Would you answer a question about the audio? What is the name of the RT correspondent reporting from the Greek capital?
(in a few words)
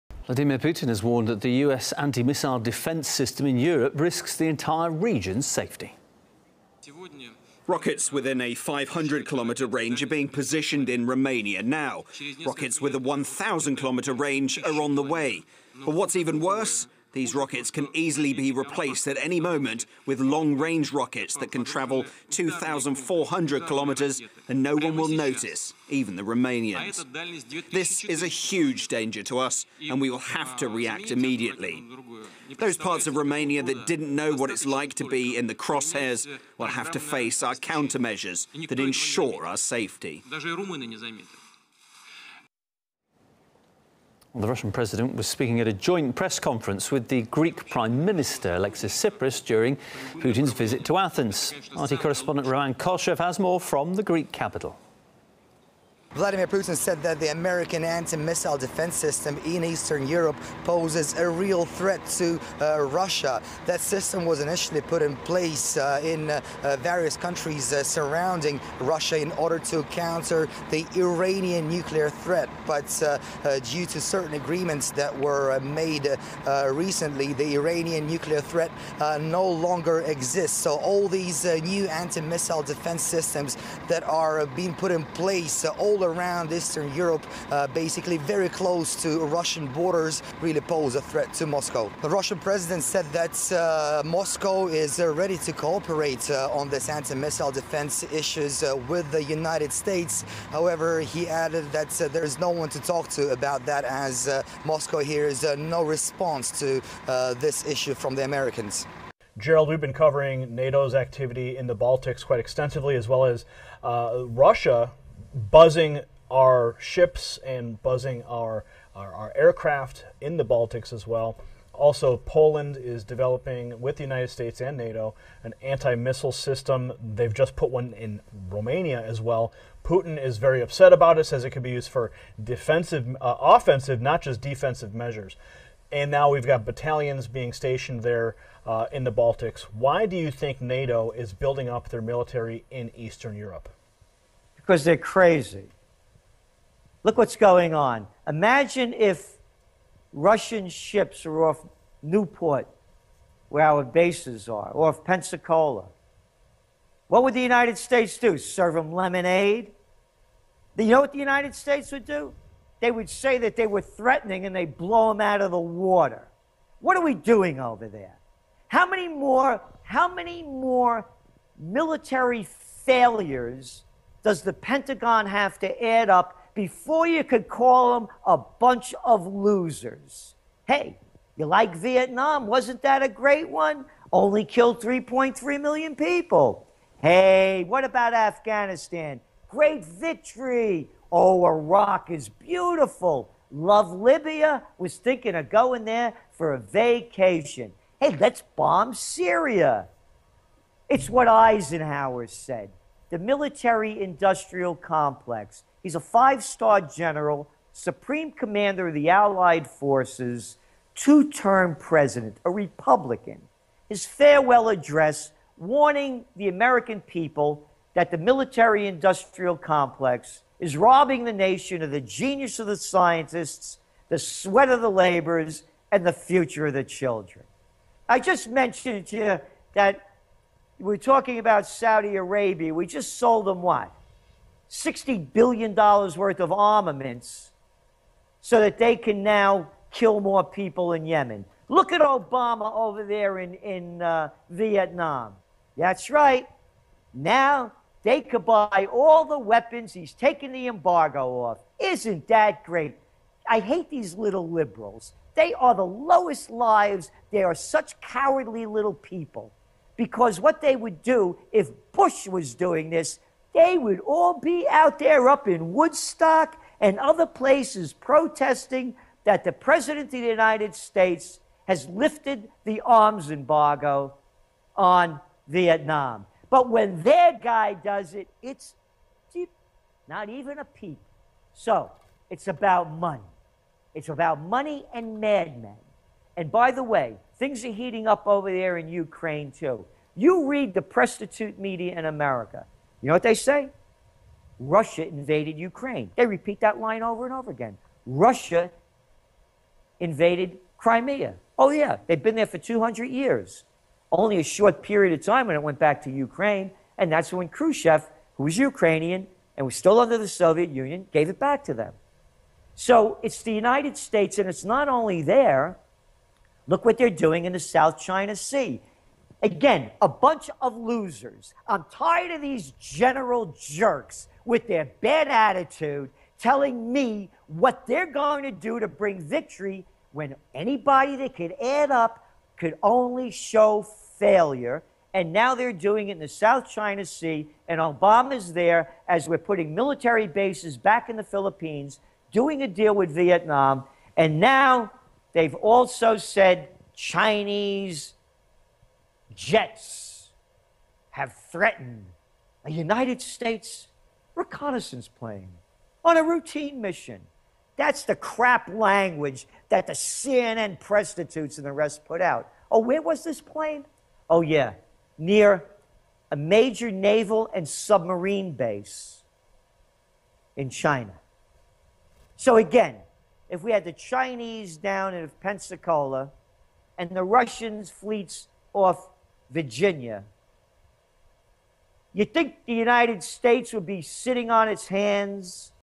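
Roman Koshchev.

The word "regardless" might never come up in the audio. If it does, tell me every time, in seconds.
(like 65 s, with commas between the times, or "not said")
not said.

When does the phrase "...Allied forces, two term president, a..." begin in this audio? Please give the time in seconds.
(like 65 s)
209 s.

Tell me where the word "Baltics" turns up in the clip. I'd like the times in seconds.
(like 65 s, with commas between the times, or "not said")
111 s, 120 s, 139 s.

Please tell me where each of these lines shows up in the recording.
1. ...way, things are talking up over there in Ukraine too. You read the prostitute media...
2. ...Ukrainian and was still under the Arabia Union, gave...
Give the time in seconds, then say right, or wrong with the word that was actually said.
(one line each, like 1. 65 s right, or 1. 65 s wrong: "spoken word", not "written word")
1. 286 s wrong: "heating", not "talking"
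2. 308 s wrong: "Soviet", not "Arabia".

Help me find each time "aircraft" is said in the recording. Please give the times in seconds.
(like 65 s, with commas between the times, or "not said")
119 s.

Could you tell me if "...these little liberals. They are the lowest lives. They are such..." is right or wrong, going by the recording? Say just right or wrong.
right.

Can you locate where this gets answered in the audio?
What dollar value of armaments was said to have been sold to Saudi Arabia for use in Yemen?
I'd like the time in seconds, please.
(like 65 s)
234 s.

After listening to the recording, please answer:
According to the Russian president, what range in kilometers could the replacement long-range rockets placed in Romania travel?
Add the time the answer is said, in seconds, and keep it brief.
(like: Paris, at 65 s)
2,400 kilometers, at 22 s.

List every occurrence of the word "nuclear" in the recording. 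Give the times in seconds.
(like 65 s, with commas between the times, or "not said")
71 s, 78 s.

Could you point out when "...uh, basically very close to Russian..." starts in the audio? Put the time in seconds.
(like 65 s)
87 s.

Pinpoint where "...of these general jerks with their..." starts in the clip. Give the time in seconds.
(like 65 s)
322 s.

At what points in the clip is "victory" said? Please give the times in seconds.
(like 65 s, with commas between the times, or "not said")
189 s, 329 s.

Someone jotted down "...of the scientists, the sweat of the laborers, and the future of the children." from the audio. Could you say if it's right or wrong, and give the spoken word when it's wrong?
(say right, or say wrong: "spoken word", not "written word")
right.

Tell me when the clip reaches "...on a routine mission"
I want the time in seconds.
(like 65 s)
356 s.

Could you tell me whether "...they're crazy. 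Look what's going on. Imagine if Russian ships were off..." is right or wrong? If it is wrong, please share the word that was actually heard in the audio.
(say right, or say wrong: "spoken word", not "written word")
right.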